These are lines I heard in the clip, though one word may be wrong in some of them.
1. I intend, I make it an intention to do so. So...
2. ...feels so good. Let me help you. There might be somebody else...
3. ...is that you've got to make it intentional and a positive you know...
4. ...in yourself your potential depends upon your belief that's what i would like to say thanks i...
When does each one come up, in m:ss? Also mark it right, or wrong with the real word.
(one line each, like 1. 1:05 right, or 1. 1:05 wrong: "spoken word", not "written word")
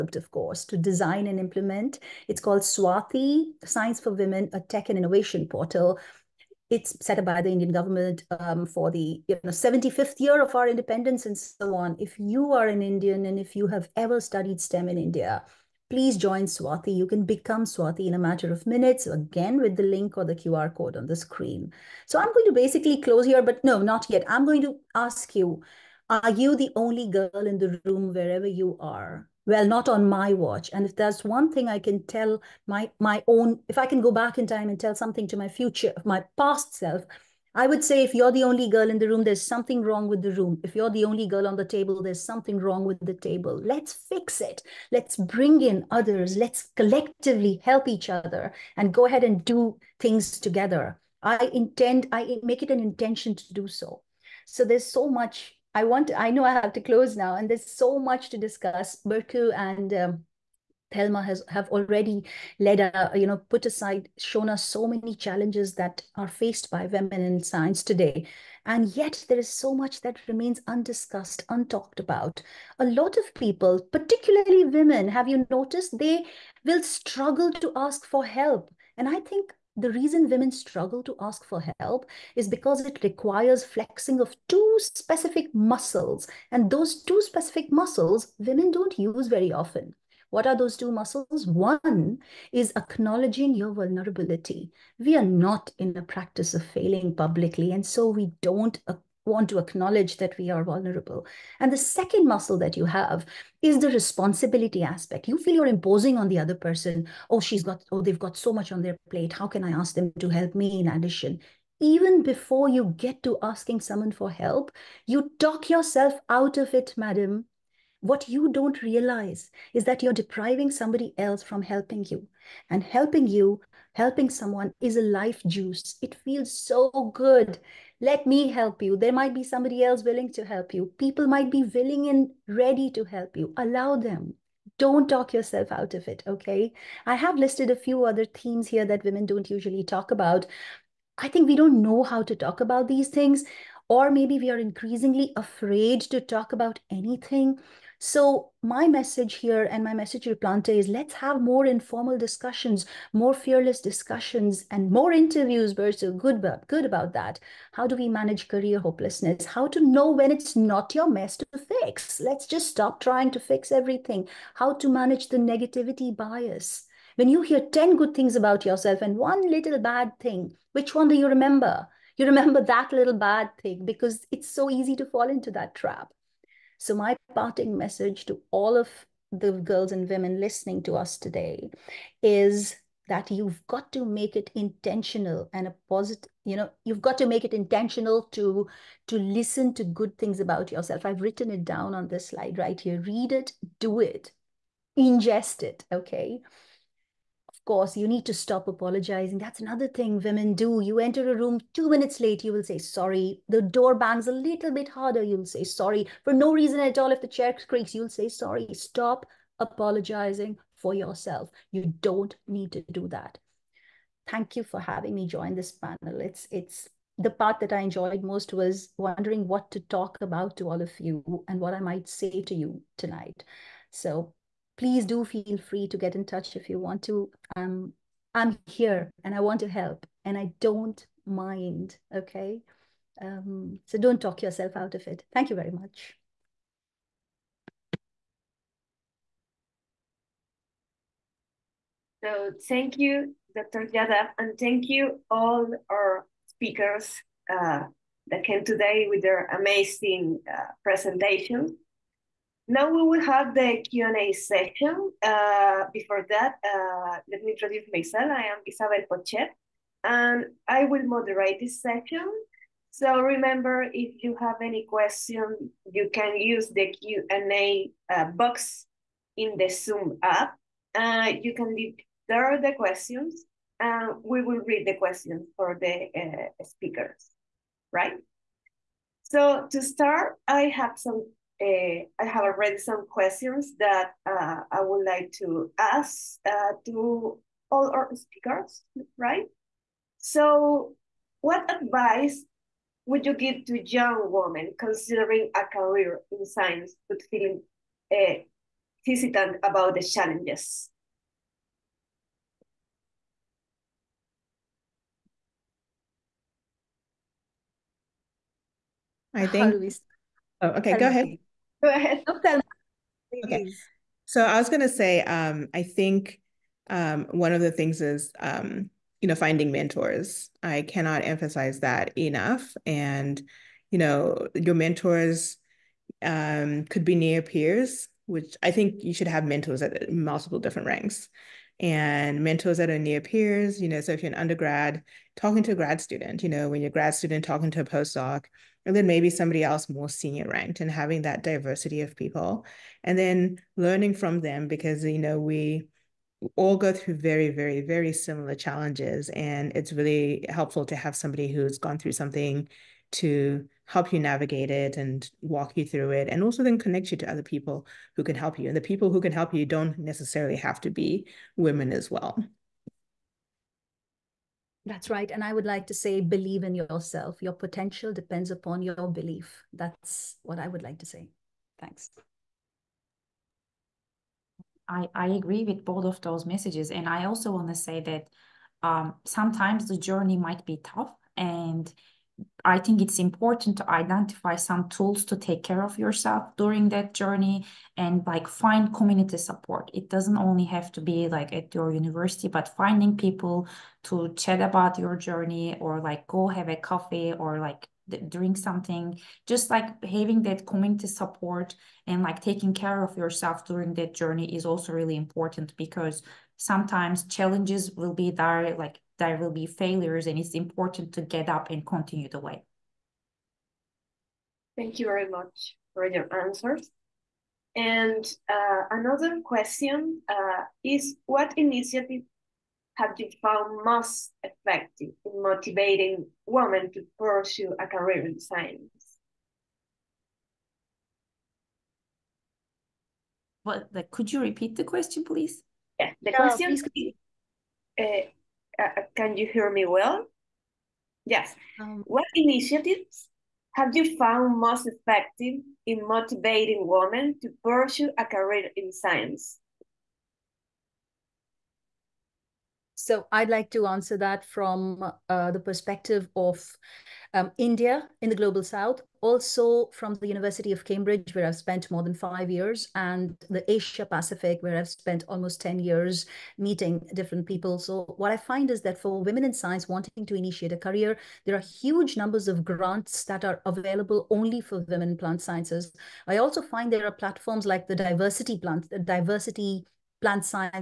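1. 0:51 right
2. 2:06 right
3. 3:02 right
4. 6:06 right.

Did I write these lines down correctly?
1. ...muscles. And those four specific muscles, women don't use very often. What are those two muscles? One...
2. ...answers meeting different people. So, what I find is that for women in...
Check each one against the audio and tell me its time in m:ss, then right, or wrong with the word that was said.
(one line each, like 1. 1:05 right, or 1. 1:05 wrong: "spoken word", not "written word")
1. 1:25 wrong: "two", not "four"
2. 7:45 wrong: "years", not "answers".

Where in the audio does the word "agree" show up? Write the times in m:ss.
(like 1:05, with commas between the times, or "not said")
6:15.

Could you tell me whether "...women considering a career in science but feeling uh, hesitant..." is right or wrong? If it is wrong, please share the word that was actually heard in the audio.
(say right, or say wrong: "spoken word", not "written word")
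right.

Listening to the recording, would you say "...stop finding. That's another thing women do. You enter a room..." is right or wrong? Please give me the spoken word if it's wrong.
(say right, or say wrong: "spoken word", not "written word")
wrong: "apologizing", not "finding".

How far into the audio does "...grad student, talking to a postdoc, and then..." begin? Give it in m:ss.
5:36.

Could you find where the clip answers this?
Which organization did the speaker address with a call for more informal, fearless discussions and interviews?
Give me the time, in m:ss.
2:30.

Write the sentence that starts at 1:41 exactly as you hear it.
And the second muscle that you have is the responsibility aspect.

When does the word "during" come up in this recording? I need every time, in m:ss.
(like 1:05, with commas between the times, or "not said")
6:26, 6:43.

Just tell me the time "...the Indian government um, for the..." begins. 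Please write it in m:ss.
0:07.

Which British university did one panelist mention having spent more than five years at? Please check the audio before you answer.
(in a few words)
University of Cambridge.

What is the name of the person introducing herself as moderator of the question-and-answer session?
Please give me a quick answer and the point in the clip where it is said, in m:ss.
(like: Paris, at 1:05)
Isabel Pochet, at 4:18.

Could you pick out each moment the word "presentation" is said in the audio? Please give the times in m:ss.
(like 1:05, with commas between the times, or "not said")
4:10.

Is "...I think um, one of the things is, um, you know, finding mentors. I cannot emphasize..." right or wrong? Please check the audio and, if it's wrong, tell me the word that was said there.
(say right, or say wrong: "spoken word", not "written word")
right.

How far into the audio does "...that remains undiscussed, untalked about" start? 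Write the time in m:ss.
1:10.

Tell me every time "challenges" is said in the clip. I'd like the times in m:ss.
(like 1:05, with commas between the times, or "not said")
1:05, 5:00, 5:48, 6:47.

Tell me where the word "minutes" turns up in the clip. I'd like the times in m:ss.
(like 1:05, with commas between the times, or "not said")
0:18, 3:21.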